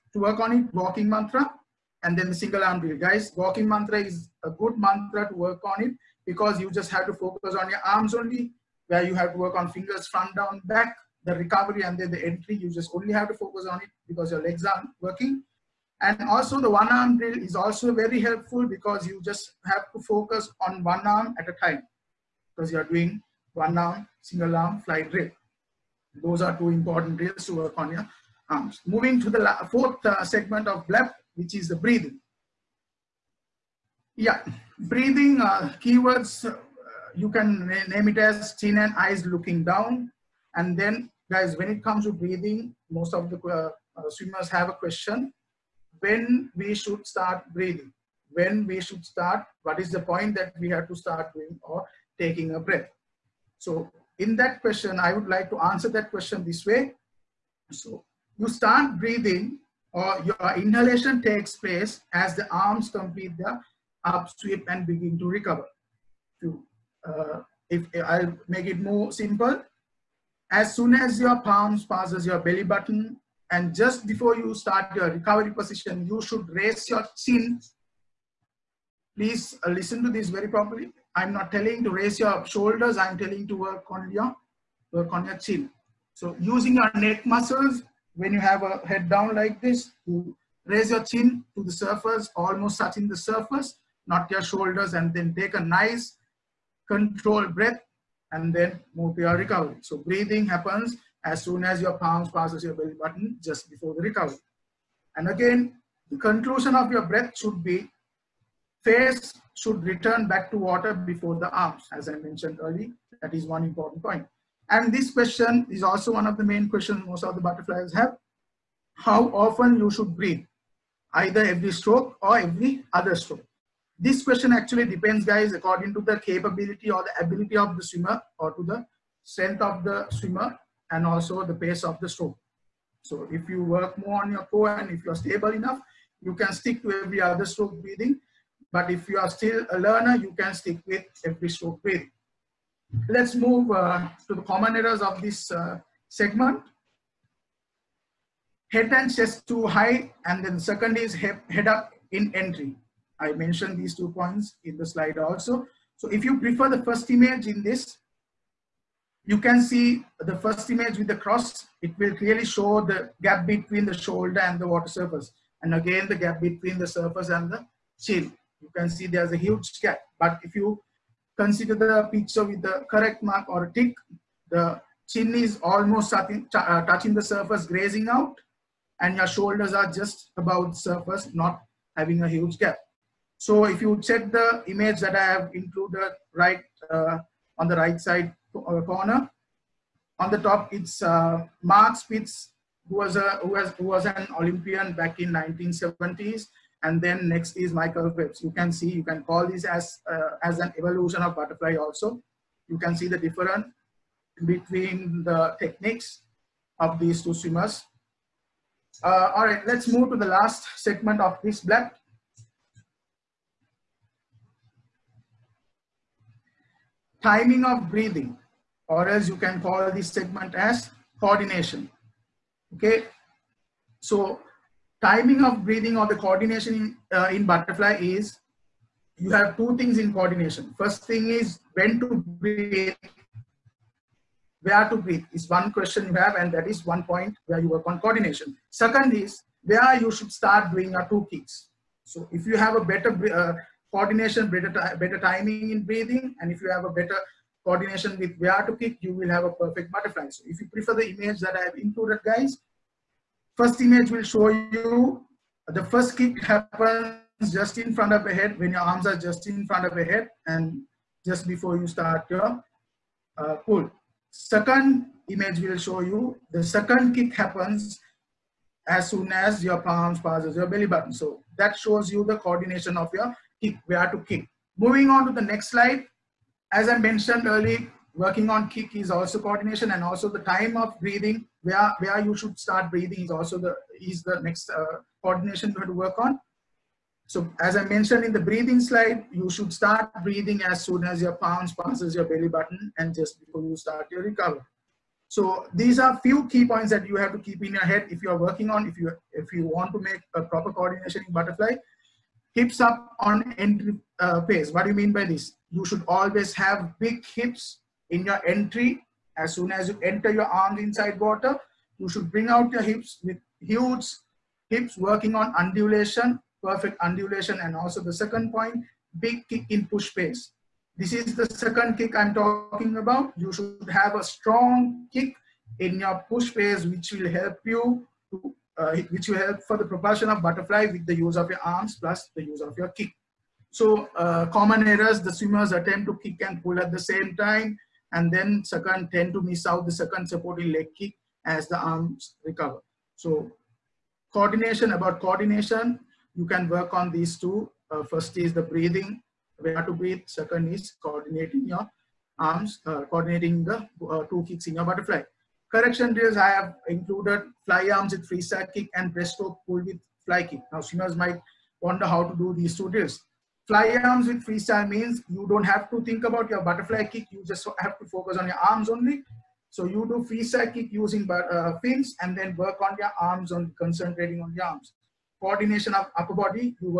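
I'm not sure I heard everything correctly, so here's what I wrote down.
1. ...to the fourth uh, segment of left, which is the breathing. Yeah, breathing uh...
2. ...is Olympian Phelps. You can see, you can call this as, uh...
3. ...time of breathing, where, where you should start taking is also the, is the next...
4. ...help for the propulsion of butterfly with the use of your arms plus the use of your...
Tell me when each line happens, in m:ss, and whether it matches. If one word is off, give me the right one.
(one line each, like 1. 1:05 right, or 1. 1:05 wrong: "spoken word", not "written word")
1. 0:29 right
2. 3:17 wrong: "Michael", not "Olympian"
3. 4:40 wrong: "breathing", not "taking"
4. 5:29 right.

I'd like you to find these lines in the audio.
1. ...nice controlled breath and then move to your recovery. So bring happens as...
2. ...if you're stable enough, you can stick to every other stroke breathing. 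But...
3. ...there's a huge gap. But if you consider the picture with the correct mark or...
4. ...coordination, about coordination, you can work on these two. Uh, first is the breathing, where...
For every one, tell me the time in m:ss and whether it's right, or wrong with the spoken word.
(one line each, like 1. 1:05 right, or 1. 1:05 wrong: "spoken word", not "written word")
1. 1:35 wrong: "breathing", not "bring"
2. 2:14 right
3. 2:49 right
4. 5:44 right.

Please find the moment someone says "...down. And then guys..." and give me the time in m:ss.
0:39.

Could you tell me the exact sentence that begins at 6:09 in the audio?
So you do freestyle kick using uh, fins and then work on your arms on concentrating on your arms.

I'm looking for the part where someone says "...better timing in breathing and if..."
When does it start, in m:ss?
4:04.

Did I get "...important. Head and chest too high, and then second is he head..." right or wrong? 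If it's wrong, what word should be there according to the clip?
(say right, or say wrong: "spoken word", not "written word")
wrong: "segment", not "important".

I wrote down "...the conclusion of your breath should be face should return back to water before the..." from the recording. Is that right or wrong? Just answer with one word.
right.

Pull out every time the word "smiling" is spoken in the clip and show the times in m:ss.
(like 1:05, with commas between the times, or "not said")
not said.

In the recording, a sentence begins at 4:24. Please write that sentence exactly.
Second image will show you the second kick happens as soon as your palms passes your belly button.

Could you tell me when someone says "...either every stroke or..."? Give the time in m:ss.
2:01.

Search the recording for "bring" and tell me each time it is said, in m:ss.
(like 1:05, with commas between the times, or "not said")
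5:12.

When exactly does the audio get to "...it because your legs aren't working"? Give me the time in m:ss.
0:13.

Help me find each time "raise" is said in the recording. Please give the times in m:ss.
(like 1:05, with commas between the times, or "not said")
1:16, 1:21, 1:30.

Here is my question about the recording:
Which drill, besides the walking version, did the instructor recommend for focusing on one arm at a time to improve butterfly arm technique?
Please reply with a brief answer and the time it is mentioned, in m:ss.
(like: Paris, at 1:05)
single arm drill, at 0:02.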